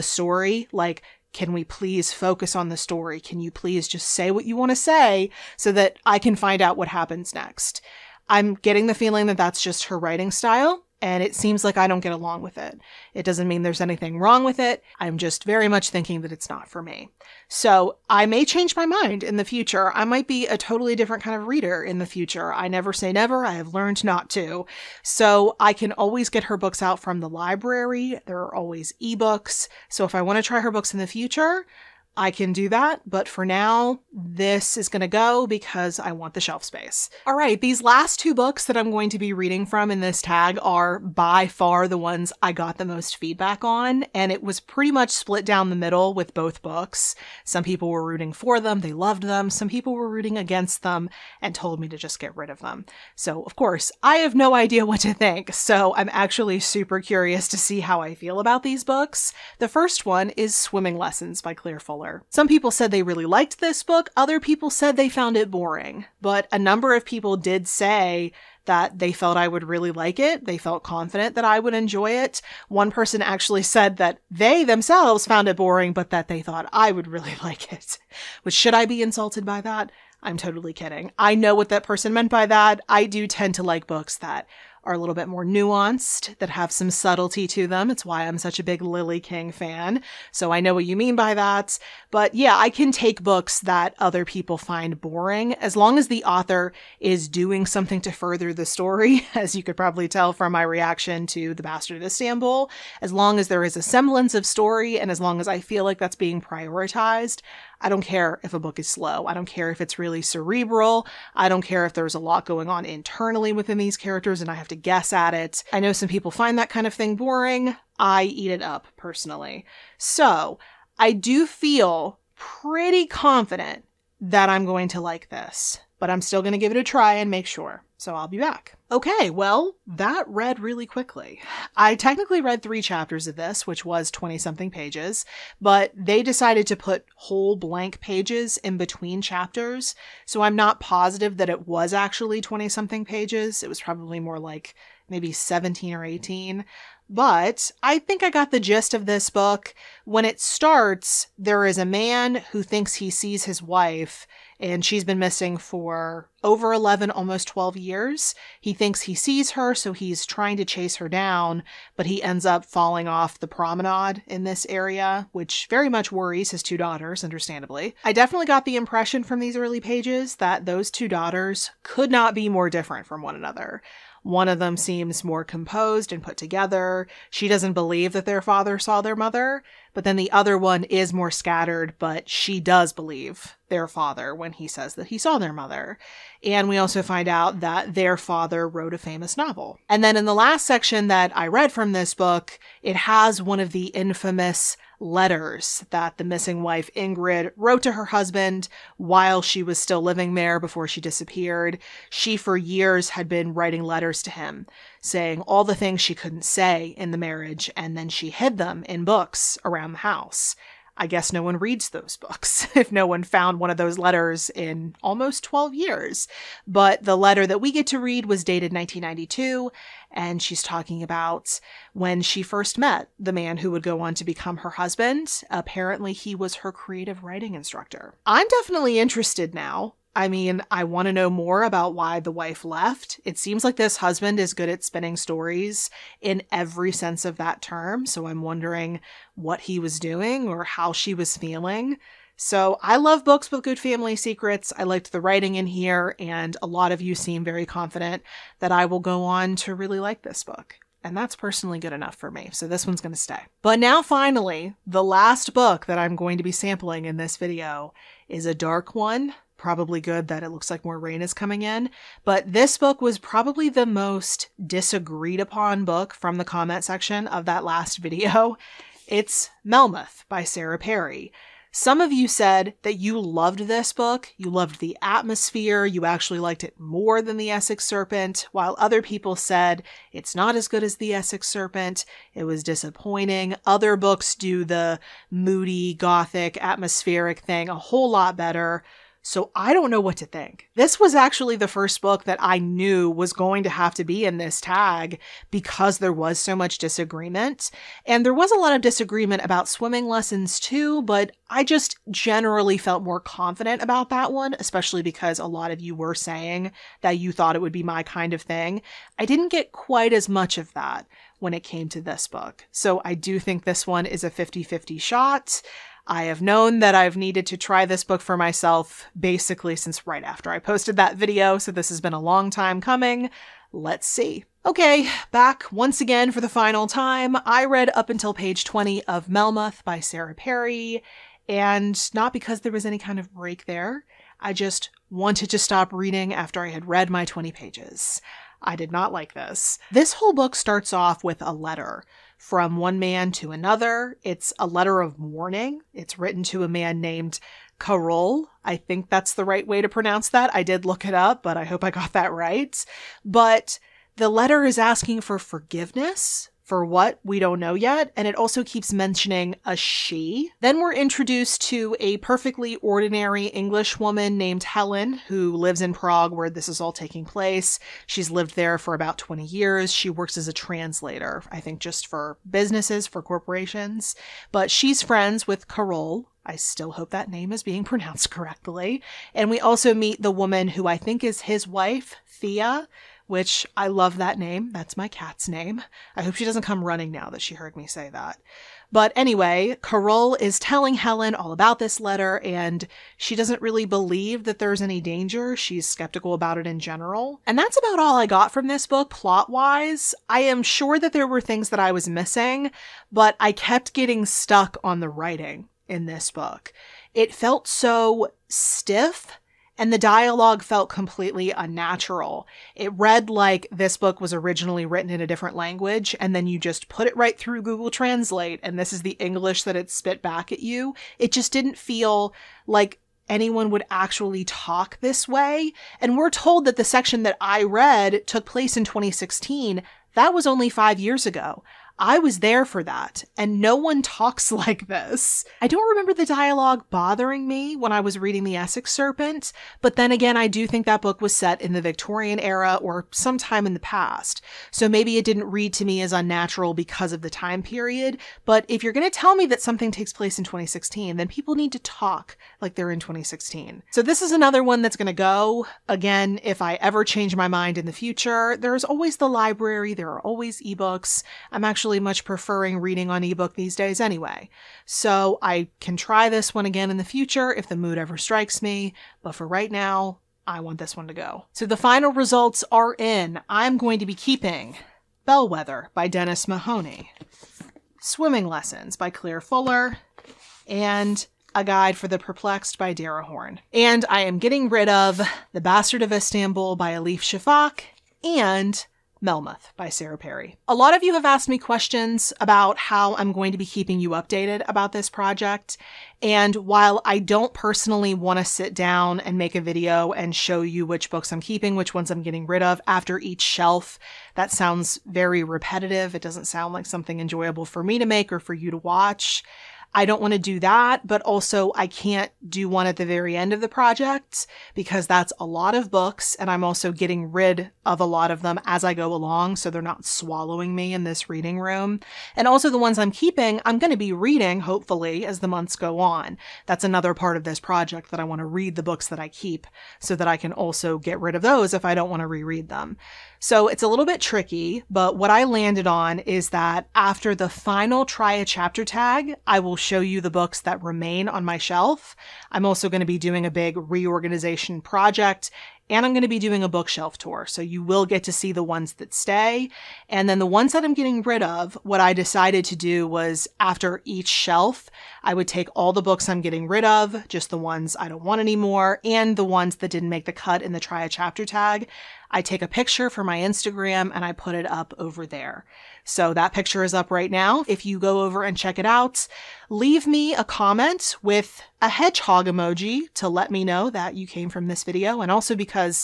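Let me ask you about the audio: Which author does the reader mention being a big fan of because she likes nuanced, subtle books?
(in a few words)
Lily King.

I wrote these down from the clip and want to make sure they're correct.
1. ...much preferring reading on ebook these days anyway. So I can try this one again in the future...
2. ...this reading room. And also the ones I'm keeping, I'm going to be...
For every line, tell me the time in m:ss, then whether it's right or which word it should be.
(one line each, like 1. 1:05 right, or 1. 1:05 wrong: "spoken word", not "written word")
1. 7:41 right
2. 8:41 right.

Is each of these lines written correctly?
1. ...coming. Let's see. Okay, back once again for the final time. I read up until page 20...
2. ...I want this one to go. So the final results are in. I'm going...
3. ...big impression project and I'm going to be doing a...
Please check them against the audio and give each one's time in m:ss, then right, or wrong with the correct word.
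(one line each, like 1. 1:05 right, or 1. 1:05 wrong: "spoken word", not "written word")
1. 5:22 right
2. 7:50 right
3. 9:03 wrong: "reorganization", not "impression".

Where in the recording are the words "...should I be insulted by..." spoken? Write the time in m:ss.
1:18.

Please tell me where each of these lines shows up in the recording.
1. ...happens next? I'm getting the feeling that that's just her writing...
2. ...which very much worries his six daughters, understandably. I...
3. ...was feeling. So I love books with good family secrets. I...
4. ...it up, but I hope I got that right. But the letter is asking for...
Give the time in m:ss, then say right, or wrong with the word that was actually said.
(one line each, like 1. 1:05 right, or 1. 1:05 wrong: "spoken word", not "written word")
1. 0:06 right
2. 2:45 wrong: "two", not "six"
3. 4:01 right
4. 5:51 right.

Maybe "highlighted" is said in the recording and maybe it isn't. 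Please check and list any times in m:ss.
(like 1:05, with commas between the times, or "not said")
not said.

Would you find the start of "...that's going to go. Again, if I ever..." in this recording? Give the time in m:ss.
7:34.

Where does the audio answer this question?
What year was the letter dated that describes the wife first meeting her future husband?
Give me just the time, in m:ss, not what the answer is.
3:38.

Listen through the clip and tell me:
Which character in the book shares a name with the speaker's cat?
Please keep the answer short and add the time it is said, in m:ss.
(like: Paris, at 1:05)
Thea, at 6:22.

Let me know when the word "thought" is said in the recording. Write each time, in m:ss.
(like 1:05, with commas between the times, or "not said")
1:16, 5:07.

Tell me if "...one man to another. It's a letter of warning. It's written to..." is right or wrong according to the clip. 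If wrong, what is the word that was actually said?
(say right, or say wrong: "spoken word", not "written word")
right.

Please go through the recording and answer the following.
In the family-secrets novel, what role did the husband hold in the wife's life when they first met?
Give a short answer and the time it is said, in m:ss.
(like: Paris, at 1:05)
creative writing instructor, at 3:46.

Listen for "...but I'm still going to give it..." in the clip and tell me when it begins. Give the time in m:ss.
2:05.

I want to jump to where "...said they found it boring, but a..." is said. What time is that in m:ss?
1:04.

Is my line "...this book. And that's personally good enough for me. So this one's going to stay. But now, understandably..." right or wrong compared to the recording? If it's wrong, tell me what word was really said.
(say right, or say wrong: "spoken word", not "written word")
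wrong: "finally", not "understandably".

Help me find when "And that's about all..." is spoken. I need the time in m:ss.
6:37.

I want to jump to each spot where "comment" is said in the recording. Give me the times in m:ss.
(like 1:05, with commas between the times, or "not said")
4:26, 9:30.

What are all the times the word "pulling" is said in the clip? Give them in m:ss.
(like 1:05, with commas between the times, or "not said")
not said.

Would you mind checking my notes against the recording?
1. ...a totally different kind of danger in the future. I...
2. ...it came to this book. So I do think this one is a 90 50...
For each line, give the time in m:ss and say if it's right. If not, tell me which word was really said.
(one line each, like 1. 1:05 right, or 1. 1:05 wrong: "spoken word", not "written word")
1. 0:20 wrong: "reader", not "danger"
2. 5:11 wrong: "50", not "90".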